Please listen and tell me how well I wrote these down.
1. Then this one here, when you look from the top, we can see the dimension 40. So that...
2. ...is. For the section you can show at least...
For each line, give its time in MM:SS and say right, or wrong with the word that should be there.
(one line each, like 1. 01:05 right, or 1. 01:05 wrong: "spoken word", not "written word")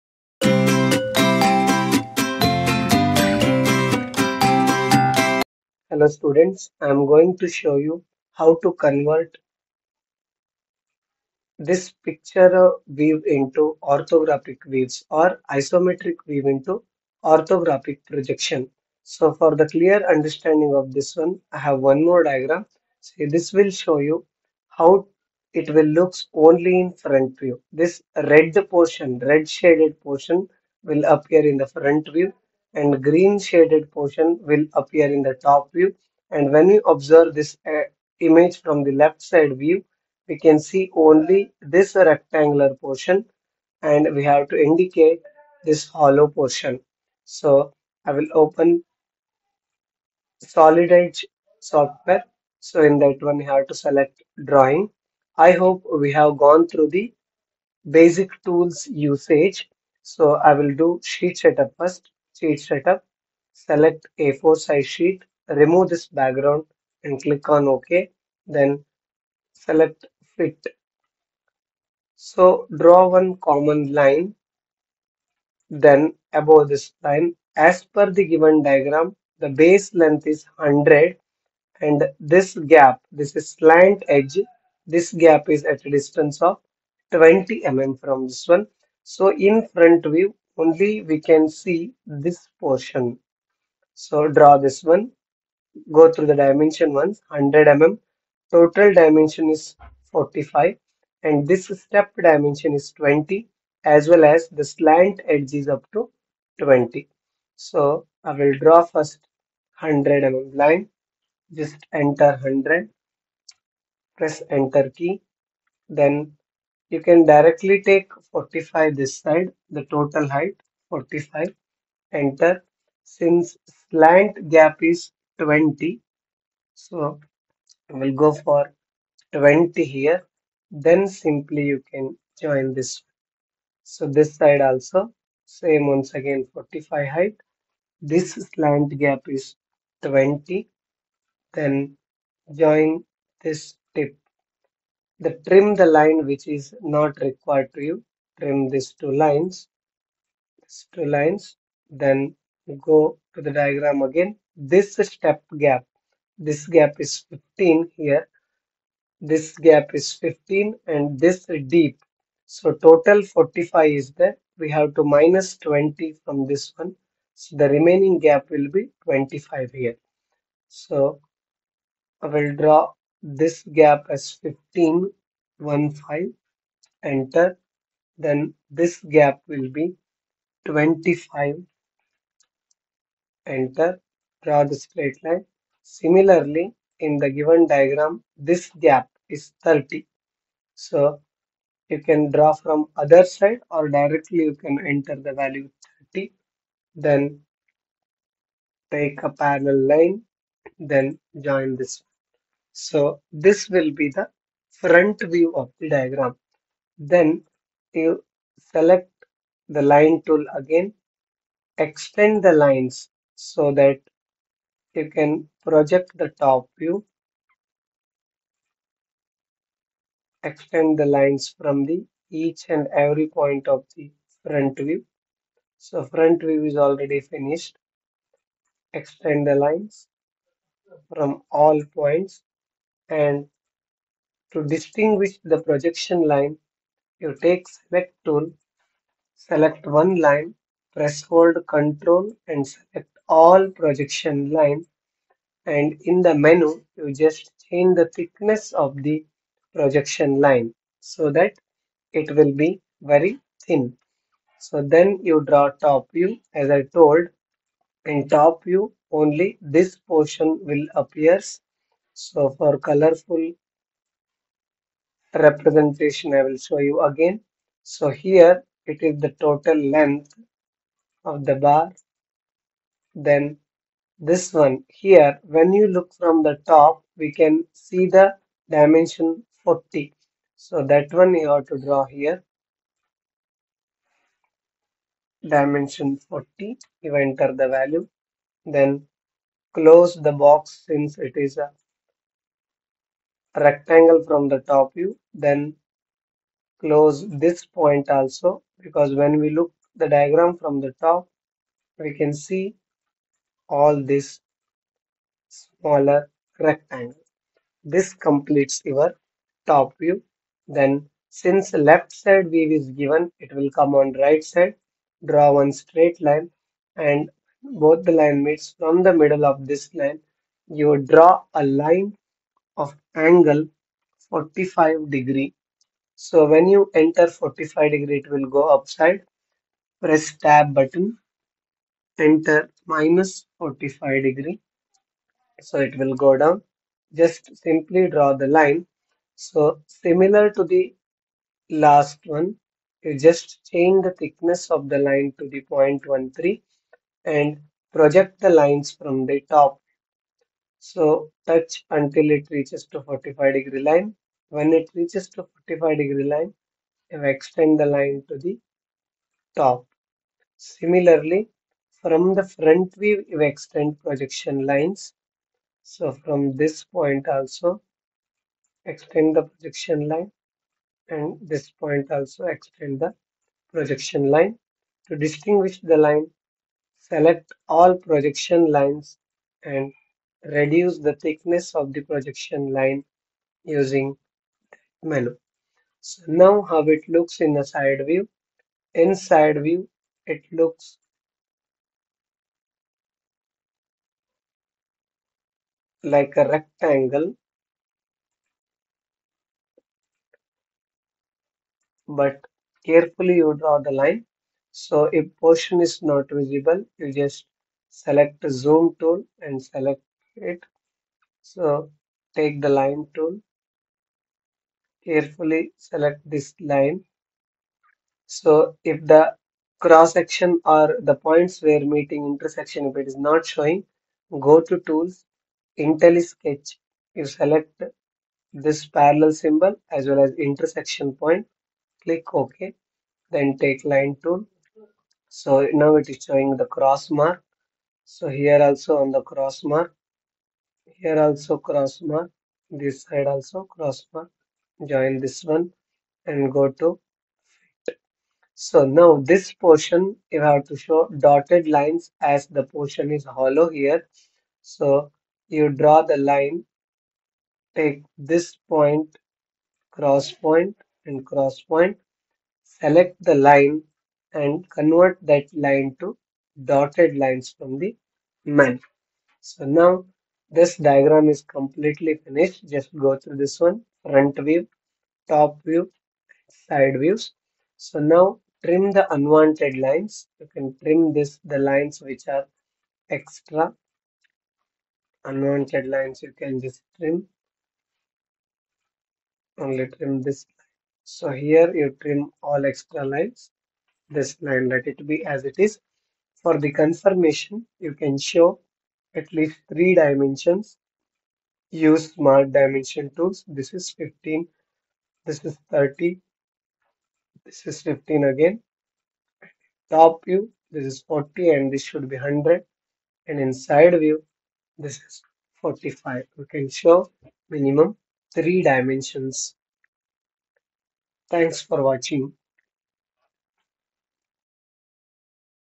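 1. 04:33 right
2. 08:15 wrong: "confirmation", not "section".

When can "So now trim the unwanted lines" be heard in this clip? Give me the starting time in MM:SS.
07:57.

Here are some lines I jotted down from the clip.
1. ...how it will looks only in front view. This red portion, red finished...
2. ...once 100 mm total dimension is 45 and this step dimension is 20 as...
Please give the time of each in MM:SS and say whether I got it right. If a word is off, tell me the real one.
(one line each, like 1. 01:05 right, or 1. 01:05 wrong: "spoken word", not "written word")
1. 00:24 wrong: "shaded", not "finished"
2. 01:37 right.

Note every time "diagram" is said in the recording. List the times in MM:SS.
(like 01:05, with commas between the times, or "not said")
00:22, 01:18, 02:33, 03:07, 03:25, 05:00, 07:50.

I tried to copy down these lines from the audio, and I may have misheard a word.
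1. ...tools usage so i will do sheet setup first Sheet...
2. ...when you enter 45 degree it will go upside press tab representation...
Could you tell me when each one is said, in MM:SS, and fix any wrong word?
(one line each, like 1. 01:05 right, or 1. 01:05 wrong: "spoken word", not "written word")
1. 00:58 right
2. 05:26 wrong: "button", not "representation".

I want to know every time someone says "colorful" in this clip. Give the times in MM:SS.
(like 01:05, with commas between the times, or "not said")
04:22.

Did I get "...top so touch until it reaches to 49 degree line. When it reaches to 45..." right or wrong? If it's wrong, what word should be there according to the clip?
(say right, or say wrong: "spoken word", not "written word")
wrong: "45", not "49".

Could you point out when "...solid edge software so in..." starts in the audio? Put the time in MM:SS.
00:50.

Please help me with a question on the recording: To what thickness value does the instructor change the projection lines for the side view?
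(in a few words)
0.13.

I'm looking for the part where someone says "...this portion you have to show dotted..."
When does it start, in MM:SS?
07:29.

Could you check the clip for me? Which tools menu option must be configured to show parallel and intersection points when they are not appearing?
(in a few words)
IntelliSketch.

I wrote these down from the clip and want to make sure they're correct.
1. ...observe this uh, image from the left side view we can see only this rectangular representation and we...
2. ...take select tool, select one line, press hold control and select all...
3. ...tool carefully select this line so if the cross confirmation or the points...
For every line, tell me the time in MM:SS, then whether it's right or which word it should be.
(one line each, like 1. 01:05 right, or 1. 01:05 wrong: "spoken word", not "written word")
1. 00:36 wrong: "portion", not "representation"
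2. 03:57 right
3. 06:53 wrong: "section", not "confirmation".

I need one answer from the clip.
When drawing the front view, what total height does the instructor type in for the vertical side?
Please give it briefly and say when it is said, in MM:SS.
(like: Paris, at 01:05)
45, at 01:59.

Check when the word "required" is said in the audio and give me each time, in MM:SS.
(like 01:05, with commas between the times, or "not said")
02:27.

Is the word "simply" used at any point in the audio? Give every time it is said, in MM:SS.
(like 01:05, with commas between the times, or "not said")
02:11, 05:37.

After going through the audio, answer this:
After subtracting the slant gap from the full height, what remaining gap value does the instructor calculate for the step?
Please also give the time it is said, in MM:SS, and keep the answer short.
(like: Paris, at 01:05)
25, at 02:47.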